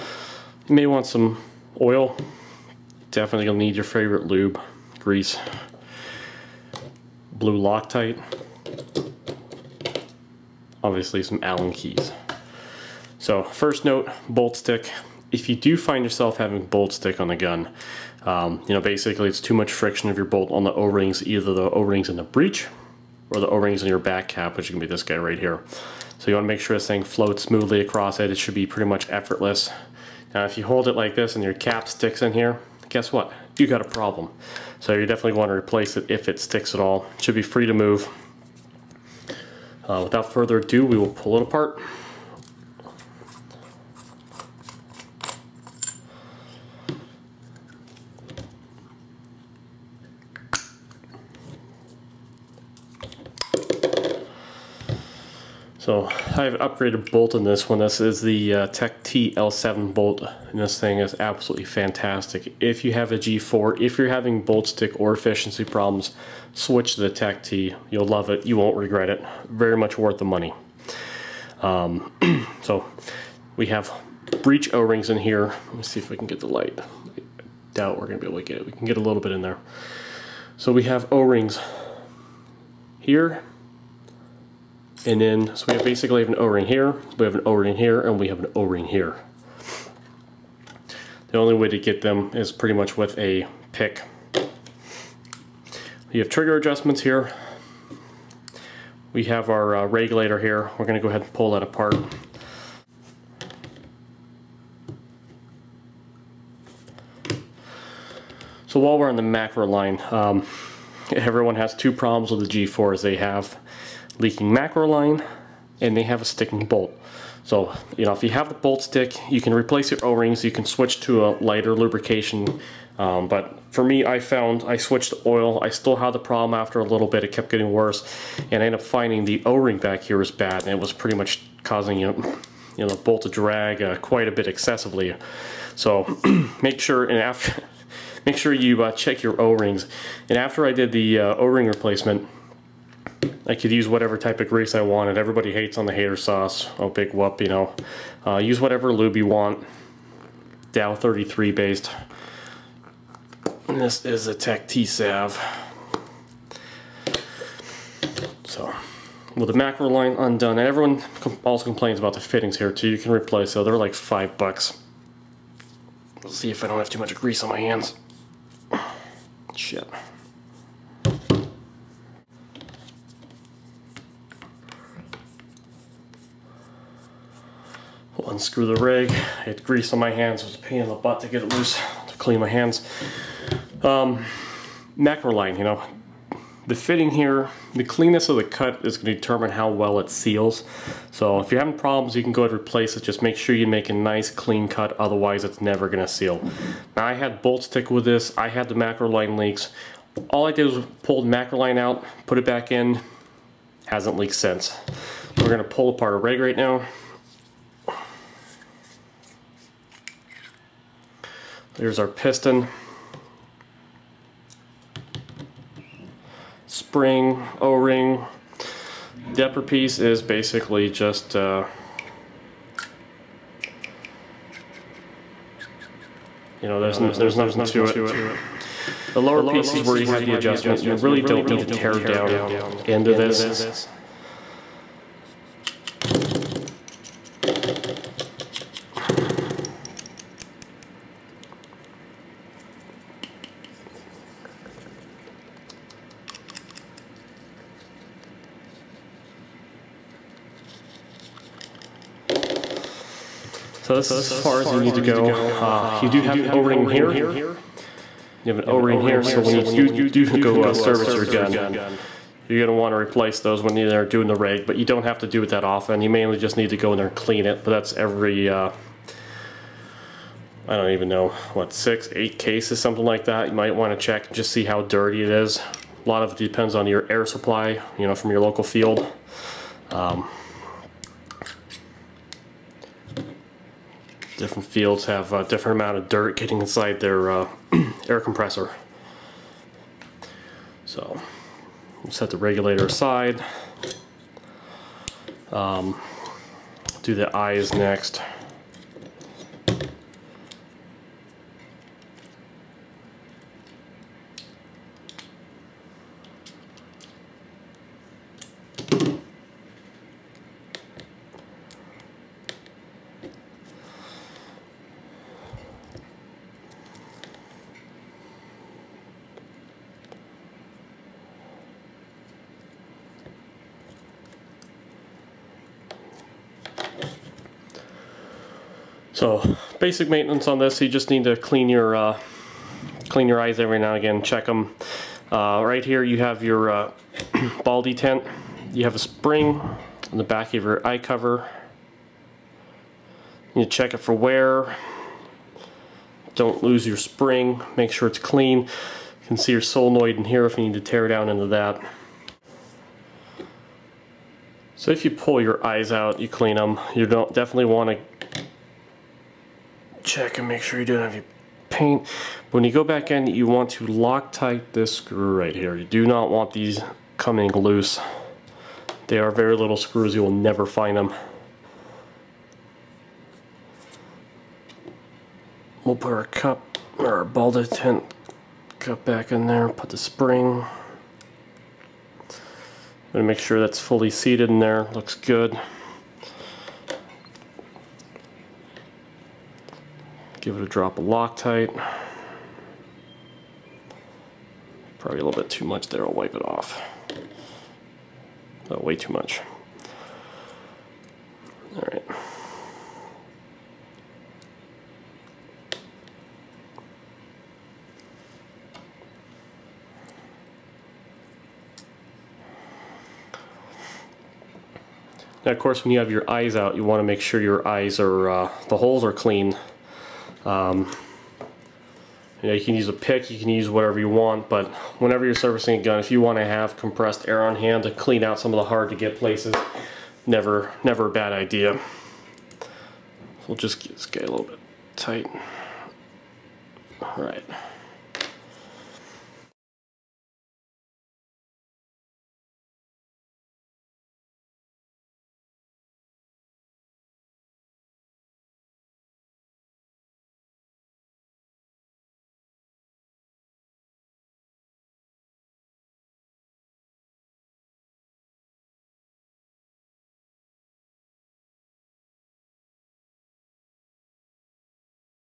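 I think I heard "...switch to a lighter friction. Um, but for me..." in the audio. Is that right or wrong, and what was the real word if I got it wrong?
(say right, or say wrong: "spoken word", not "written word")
wrong: "lubrication", not "friction".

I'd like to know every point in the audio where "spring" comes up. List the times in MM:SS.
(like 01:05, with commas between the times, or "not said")
03:36, 05:38, 05:46, 06:19.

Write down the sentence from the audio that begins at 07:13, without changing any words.
We'll just get this guy a little bit tight.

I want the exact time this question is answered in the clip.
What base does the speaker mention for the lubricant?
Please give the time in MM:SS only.
02:30.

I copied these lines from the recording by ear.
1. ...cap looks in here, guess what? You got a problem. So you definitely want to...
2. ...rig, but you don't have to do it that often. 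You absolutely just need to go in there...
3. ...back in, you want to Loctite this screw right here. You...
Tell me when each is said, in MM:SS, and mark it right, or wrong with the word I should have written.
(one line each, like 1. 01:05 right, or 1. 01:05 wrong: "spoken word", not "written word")
1. 00:31 wrong: "sticks", not "looks"
2. 04:24 wrong: "mainly", not "absolutely"
3. 06:02 right.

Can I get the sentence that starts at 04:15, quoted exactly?
Uh, you do have an O-ring here.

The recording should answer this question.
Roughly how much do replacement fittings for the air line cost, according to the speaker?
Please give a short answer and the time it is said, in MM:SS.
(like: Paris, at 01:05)
5 dollars, at 02:43.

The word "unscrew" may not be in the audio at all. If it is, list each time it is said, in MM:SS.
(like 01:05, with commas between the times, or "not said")
02:58.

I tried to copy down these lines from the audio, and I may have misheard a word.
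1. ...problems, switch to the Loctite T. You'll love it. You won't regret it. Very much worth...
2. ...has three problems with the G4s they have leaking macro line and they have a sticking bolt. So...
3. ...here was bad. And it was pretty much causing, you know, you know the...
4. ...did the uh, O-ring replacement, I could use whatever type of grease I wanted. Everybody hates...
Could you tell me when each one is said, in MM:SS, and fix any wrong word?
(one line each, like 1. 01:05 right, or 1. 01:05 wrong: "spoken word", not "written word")
1. 01:05 wrong: "Tech", not "Loctite"
2. 01:51 wrong: "two", not "three"
3. 02:10 right
4. 02:20 right.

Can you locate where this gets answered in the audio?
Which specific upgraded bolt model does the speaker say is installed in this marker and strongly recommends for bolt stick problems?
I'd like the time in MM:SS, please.
00:58.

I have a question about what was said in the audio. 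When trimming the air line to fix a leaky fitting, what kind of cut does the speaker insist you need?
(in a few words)
A nice clean cut.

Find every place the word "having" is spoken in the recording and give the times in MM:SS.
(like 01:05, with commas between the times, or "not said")
00:16, 01:04, 03:11.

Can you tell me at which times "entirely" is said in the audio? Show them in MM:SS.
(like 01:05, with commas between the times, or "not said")
not said.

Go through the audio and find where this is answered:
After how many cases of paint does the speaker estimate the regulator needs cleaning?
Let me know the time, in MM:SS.
04:31.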